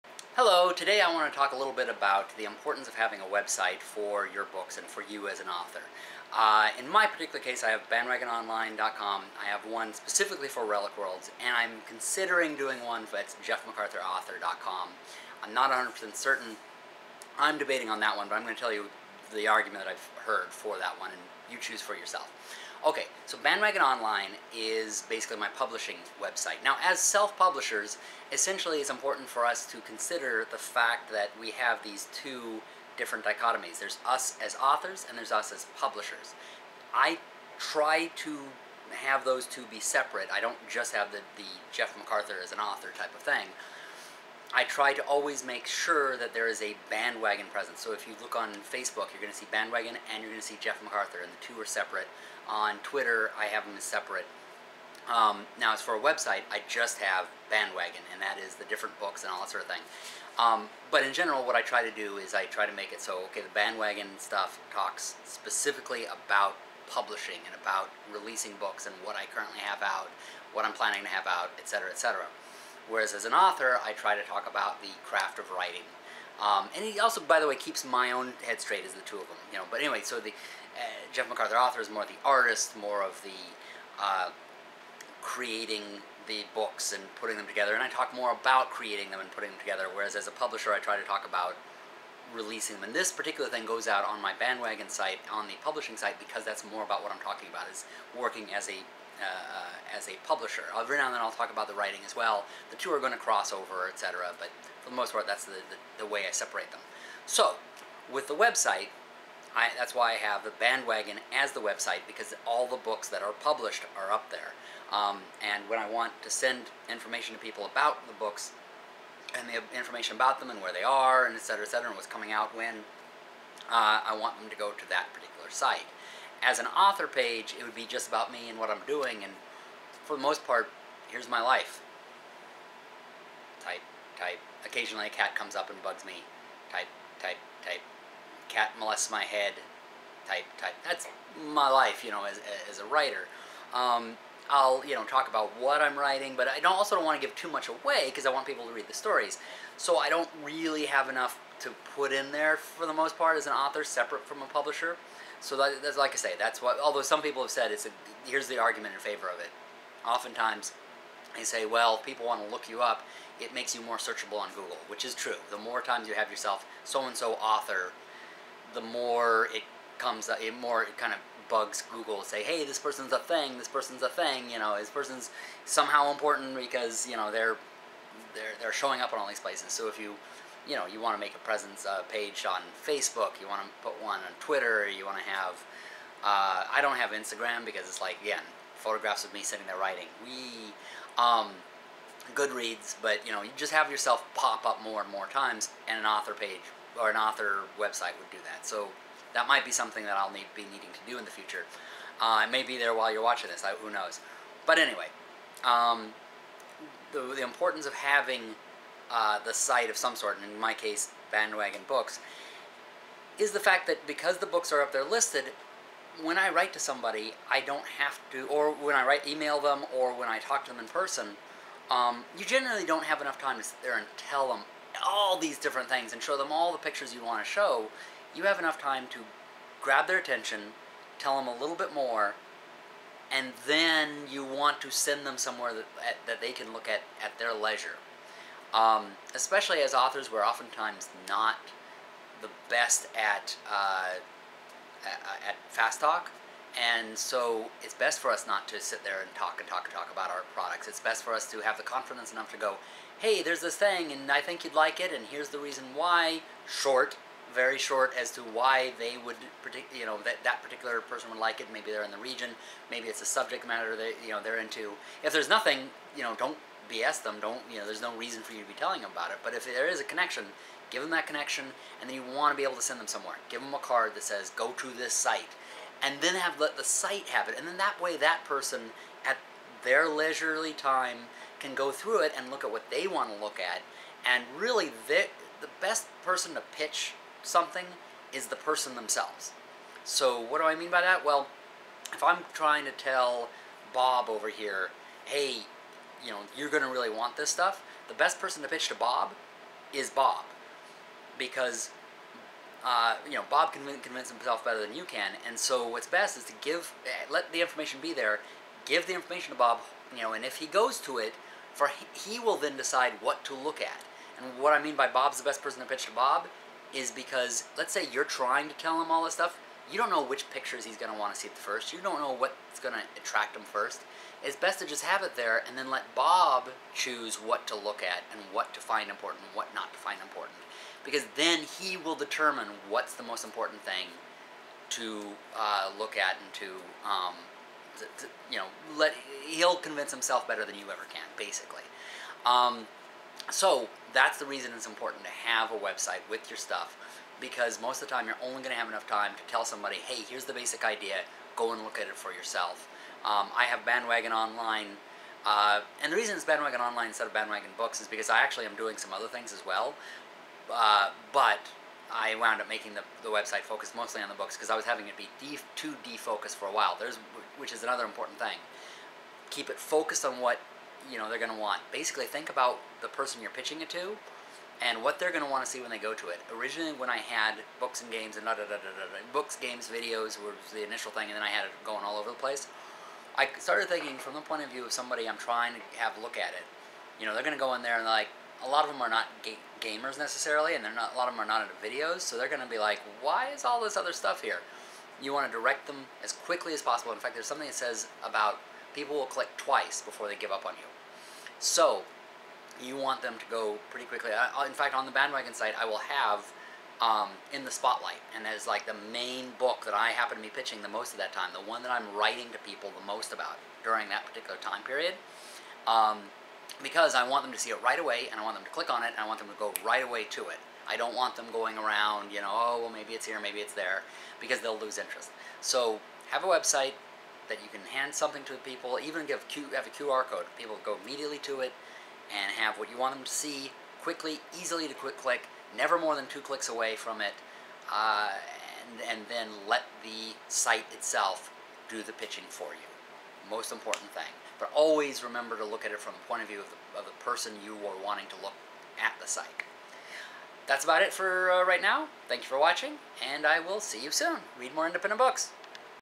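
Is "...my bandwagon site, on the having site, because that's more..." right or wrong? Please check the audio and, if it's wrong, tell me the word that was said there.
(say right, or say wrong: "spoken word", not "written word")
wrong: "publishing", not "having".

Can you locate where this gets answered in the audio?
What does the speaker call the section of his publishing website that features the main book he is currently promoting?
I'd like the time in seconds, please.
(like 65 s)
407 s.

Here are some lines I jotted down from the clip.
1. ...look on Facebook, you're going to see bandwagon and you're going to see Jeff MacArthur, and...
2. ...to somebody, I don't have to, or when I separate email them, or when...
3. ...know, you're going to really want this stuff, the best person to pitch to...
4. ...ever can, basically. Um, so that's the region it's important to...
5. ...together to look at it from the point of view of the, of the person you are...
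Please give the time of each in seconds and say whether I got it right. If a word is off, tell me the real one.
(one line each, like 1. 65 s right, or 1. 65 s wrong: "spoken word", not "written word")
1. 48 s right
2. 216 s wrong: "write", not "separate"
3. 296 s right
4. 340 s wrong: "reason", not "region"
5. 445 s wrong: "remember", not "together".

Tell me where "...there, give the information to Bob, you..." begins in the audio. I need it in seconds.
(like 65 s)
308 s.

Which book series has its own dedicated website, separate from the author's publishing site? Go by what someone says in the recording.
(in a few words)
Relic Worlds.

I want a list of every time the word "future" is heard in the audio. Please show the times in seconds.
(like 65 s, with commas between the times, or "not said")
201 s.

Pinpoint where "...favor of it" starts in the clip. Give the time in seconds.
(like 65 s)
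158 s.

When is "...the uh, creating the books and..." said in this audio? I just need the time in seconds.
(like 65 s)
83 s.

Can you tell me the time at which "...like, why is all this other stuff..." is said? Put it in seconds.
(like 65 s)
392 s.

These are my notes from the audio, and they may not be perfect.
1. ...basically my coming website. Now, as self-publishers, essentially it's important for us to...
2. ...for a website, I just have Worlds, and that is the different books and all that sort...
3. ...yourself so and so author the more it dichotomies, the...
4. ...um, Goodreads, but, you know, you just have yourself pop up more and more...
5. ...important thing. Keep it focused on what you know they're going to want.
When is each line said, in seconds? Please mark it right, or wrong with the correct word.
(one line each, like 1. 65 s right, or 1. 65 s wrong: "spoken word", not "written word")
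1. 25 s wrong: "publishing", not "coming"
2. 55 s wrong: "Bandwagon", not "Worlds"
3. 166 s wrong: "comes", not "dichotomies"
4. 191 s right
5. 368 s right.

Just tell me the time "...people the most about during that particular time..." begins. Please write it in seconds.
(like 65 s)
412 s.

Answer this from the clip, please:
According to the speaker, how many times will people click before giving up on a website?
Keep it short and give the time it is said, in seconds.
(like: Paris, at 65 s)
2, at 399 s.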